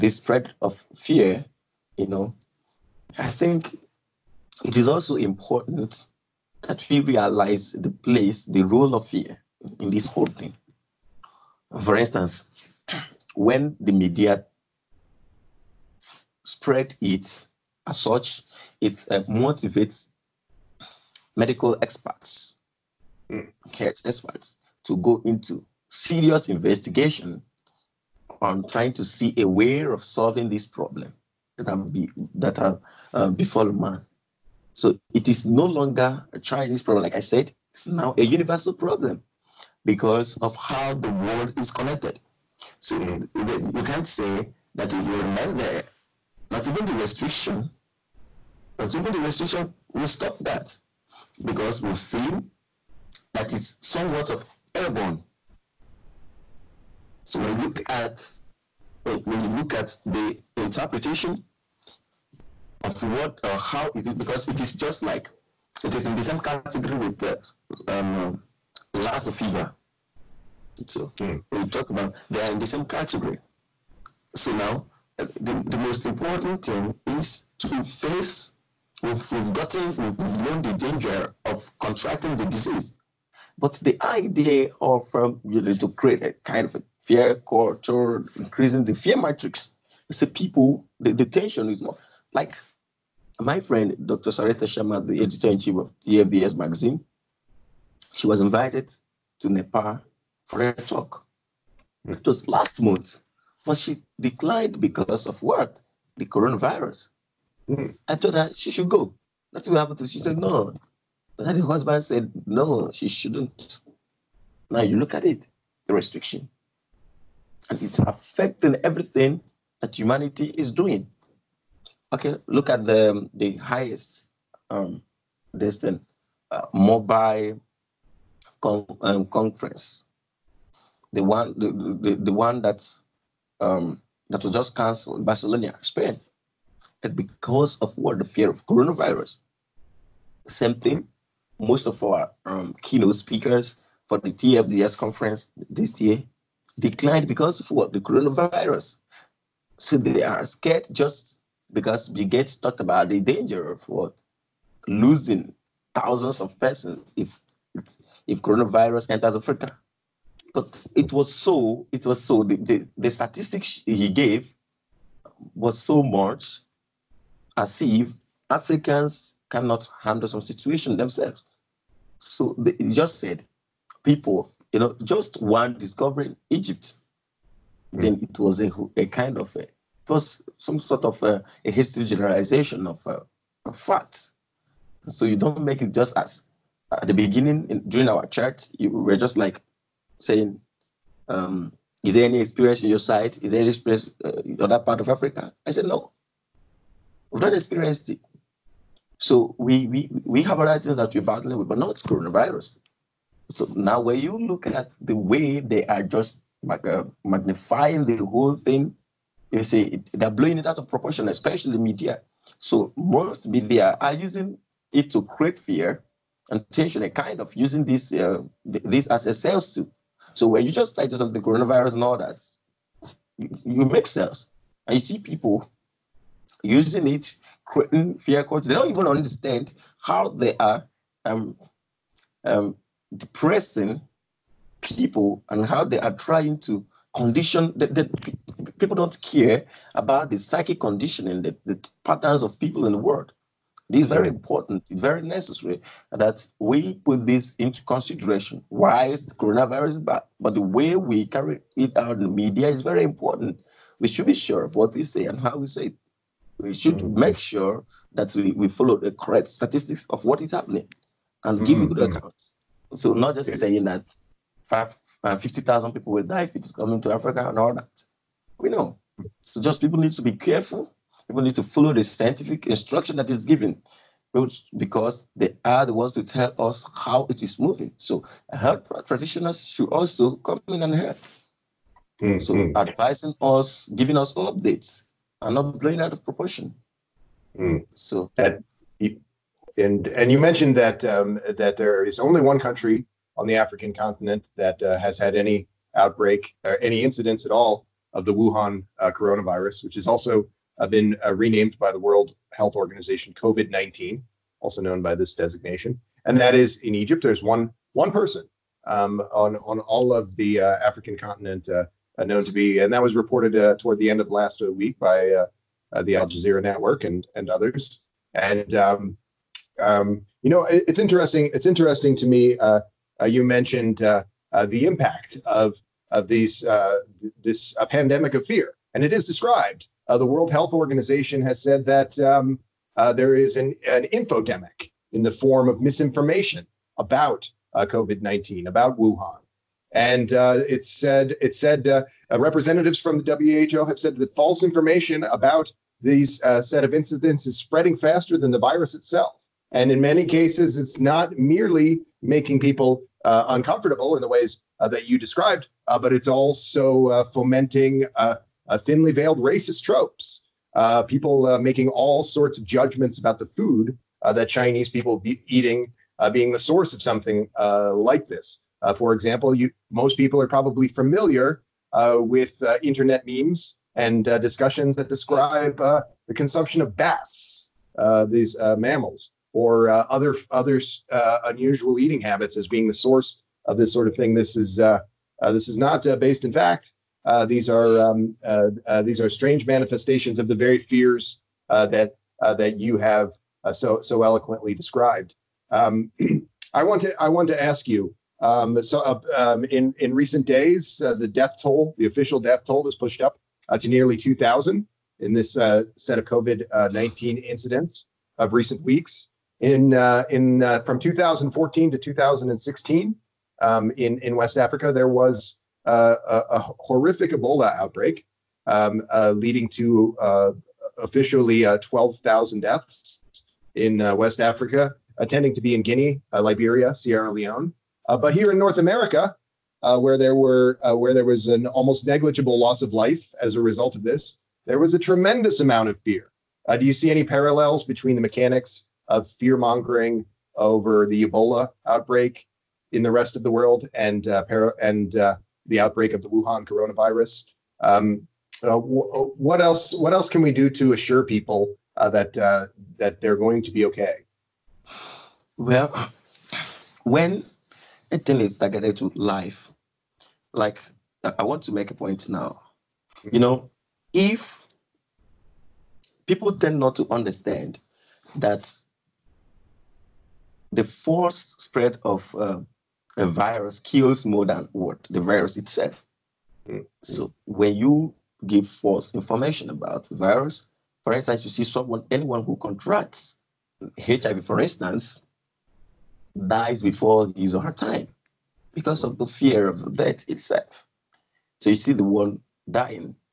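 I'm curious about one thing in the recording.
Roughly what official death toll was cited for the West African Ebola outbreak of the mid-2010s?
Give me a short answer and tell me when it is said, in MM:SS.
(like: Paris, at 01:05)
12,000, at 07:01.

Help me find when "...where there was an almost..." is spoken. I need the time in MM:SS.
07:10.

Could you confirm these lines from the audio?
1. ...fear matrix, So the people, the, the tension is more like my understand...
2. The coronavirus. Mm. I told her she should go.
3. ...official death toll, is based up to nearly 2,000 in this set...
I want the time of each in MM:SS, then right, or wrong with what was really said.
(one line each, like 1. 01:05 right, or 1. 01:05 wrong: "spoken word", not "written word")
1. 01:28 wrong: "friend", not "understand"
2. 01:46 right
3. 06:42 wrong: "pushed", not "based".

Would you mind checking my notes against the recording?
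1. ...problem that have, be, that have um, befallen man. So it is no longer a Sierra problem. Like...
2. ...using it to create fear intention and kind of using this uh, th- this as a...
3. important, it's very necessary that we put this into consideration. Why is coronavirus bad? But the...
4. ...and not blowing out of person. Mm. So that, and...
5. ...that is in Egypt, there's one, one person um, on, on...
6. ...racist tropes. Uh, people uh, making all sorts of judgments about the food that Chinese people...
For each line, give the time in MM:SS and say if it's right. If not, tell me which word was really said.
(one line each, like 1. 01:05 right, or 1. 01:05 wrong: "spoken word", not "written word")
1. 00:30 wrong: "Chinese", not "Sierra"
2. 03:34 right
3. 04:04 right
4. 04:45 wrong: "proportion", not "person"
5. 05:06 right
6. 05:59 right.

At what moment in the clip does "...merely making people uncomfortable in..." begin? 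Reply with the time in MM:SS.
05:51.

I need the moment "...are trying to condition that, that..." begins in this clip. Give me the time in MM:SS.
03:55.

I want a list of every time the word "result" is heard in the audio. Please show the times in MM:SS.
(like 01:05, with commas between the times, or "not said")
07:13.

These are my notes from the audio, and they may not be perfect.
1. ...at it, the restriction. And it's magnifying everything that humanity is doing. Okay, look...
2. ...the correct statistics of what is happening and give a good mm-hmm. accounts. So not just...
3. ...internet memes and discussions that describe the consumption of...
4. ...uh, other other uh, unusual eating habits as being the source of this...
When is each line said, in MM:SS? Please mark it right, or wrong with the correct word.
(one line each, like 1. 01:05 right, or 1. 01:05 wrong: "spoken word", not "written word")
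1. 01:55 wrong: "affecting", not "magnifying"
2. 04:18 right
3. 06:12 right
4. 06:19 right.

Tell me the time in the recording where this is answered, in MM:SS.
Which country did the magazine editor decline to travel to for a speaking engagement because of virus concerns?
01:39.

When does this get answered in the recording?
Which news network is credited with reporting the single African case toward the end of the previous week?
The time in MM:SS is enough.
05:16.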